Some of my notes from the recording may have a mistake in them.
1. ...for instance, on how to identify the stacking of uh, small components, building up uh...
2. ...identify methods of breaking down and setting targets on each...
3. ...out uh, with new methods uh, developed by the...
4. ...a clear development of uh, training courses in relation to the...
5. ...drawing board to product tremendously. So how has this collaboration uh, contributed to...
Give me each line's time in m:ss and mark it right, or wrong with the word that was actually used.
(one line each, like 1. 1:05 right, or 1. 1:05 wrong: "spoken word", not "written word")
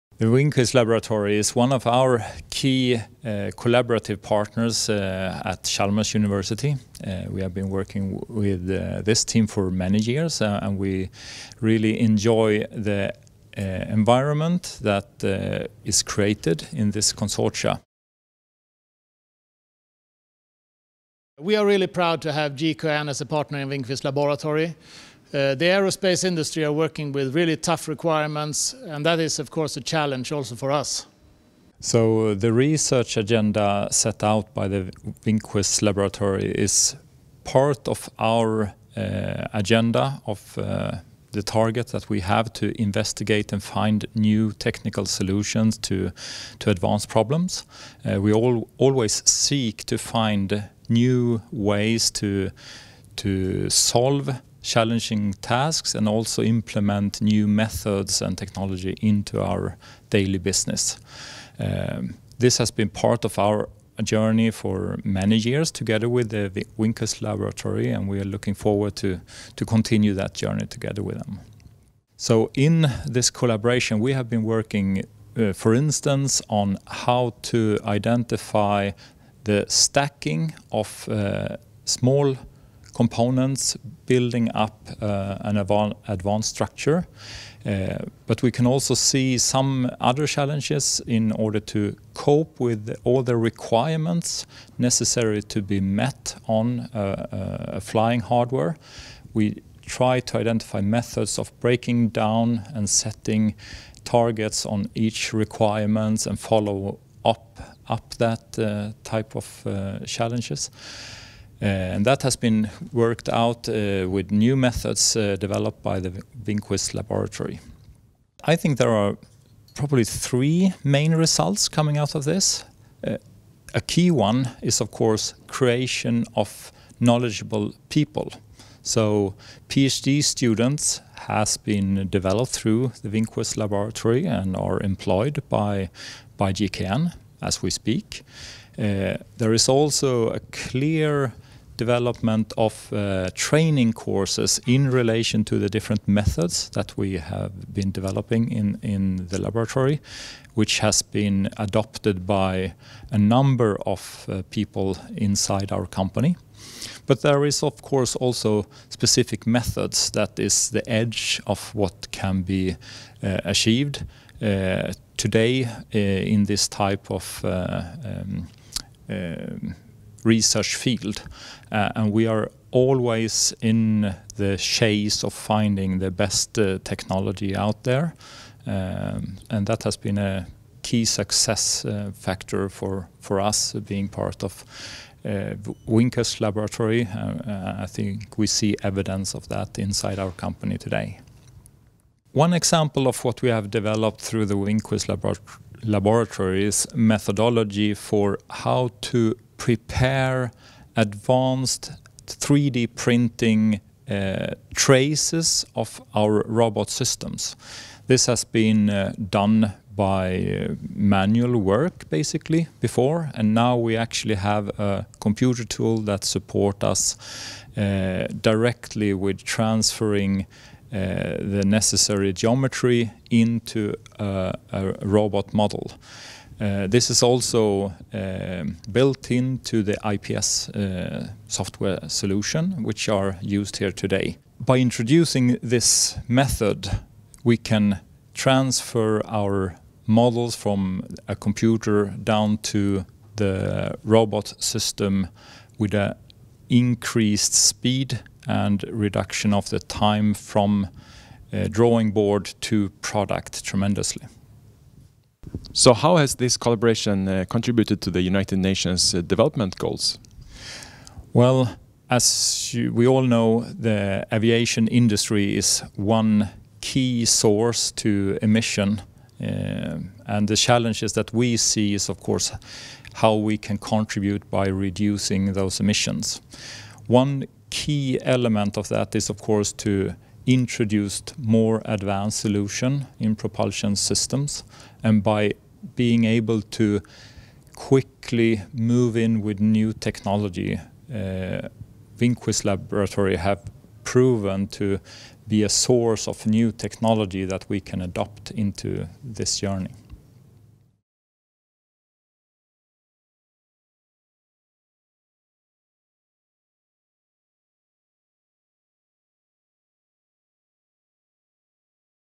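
1. 1:15 right
2. 1:40 right
3. 1:53 right
4. 2:20 right
5. 4:11 right.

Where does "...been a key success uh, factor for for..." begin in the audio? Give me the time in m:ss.
2:59.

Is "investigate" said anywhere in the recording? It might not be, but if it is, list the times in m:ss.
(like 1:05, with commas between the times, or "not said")
0:42.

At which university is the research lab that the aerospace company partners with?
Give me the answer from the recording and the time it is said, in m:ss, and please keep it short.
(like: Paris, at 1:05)
Chalmers University, at 0:05.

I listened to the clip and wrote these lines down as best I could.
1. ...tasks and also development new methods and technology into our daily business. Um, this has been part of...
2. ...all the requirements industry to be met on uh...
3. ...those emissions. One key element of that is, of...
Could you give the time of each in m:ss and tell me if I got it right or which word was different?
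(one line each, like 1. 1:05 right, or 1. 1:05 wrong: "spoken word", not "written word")
1. 0:55 wrong: "implement", not "development"
2. 1:33 wrong: "necessary", not "industry"
3. 4:35 right.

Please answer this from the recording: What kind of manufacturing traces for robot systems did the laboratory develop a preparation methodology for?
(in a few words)
3D printing.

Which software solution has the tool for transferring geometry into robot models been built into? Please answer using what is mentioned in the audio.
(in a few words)
IPS.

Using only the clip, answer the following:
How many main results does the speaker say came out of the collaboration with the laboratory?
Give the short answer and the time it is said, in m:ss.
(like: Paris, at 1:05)
3, at 2:00.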